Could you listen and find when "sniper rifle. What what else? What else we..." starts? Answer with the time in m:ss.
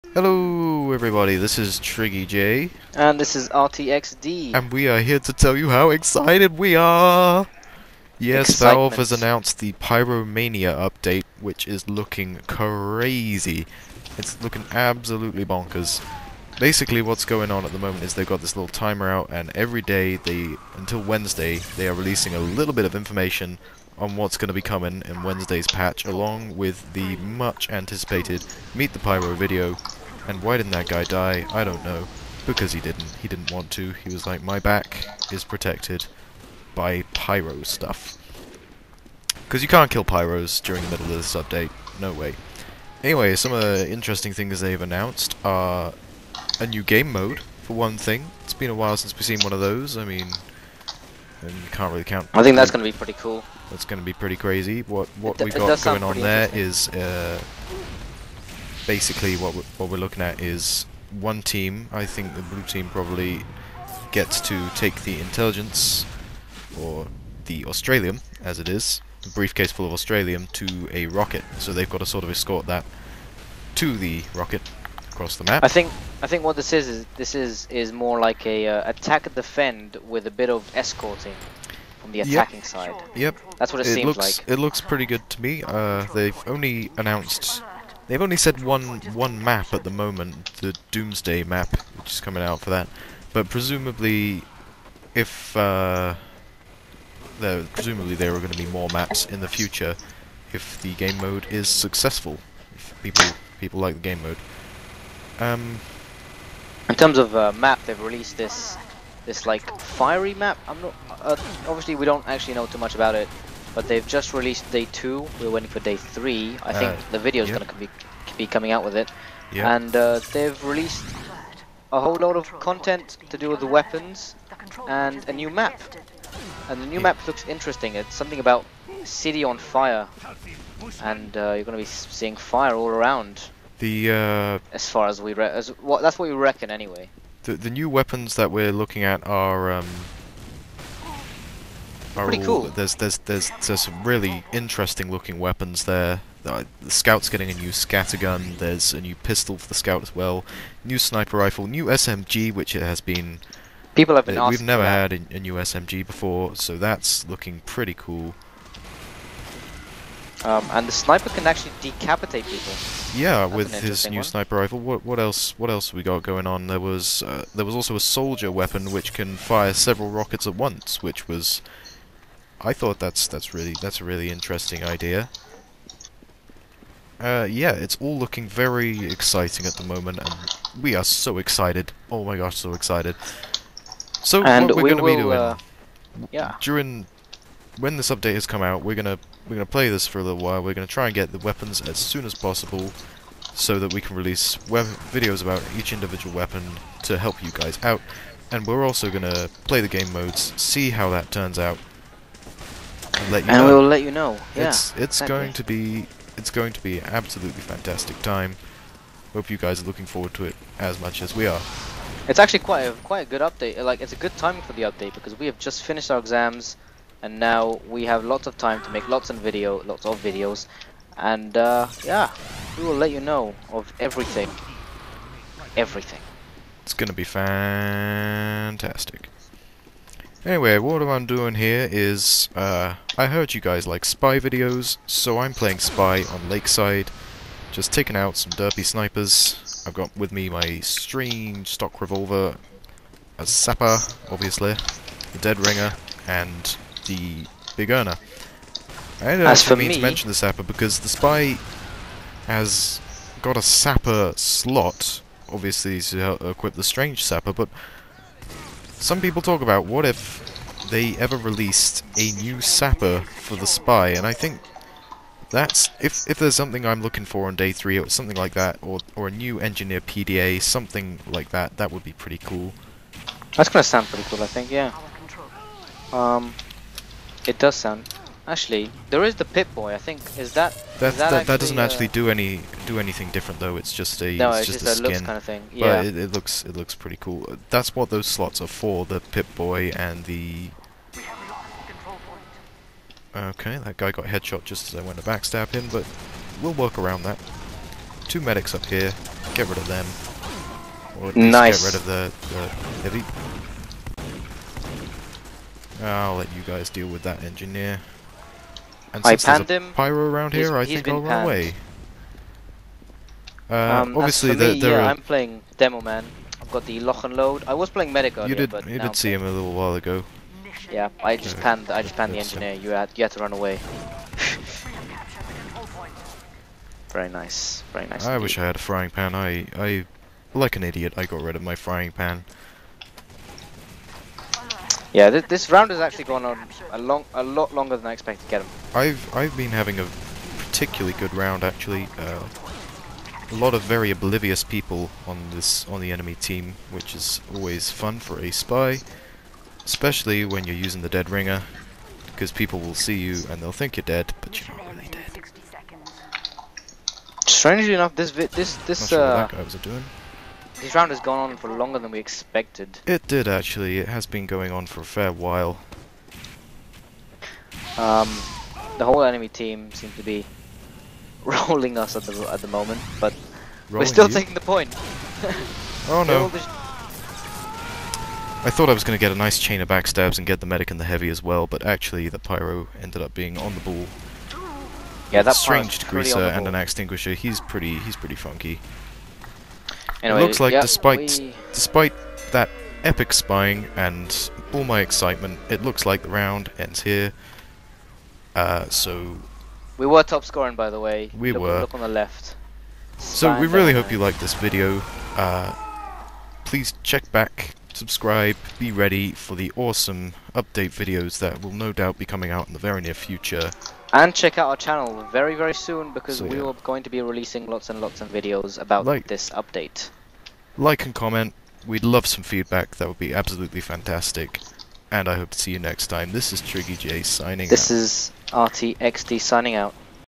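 2:44.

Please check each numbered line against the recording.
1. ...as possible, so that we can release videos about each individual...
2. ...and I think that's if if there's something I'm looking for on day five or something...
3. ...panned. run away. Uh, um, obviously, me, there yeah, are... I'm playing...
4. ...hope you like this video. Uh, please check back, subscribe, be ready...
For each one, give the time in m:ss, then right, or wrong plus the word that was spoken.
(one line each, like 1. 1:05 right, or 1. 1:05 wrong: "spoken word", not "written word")
1. 3:12 right
2. 4:24 wrong: "three", not "five"
3. 5:11 right
4. 6:43 right.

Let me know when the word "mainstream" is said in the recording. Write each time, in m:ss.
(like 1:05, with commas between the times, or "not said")
not said.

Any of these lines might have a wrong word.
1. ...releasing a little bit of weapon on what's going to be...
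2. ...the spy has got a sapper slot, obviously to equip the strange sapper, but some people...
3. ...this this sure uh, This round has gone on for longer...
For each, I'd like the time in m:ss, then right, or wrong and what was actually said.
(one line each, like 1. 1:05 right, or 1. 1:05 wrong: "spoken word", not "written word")
1. 0:21 wrong: "information", not "weapon"
2. 4:11 right
3. 5:58 right.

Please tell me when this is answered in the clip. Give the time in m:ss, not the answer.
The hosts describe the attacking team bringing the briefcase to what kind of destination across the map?
1:10.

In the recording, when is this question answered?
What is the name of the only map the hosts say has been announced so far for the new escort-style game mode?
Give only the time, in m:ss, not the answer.
1:30.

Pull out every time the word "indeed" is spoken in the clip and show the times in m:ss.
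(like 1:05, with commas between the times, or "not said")
5:28.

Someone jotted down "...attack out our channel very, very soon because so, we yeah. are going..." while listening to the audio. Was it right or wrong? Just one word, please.
wrong.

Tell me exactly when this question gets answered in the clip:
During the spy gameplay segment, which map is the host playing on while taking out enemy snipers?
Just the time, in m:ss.
3:56.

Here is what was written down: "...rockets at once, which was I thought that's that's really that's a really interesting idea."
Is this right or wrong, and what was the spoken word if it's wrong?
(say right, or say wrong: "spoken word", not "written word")
right.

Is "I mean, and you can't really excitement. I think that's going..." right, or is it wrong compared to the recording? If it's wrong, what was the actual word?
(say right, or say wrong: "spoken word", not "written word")
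wrong: "count", not "excitement".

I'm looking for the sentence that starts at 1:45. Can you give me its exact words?
Um, in terms of uh, map, they've released this this like fiery map.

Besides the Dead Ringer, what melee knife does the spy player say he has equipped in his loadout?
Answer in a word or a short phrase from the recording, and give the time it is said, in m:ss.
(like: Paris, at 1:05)
the Big Earner, at 4:07.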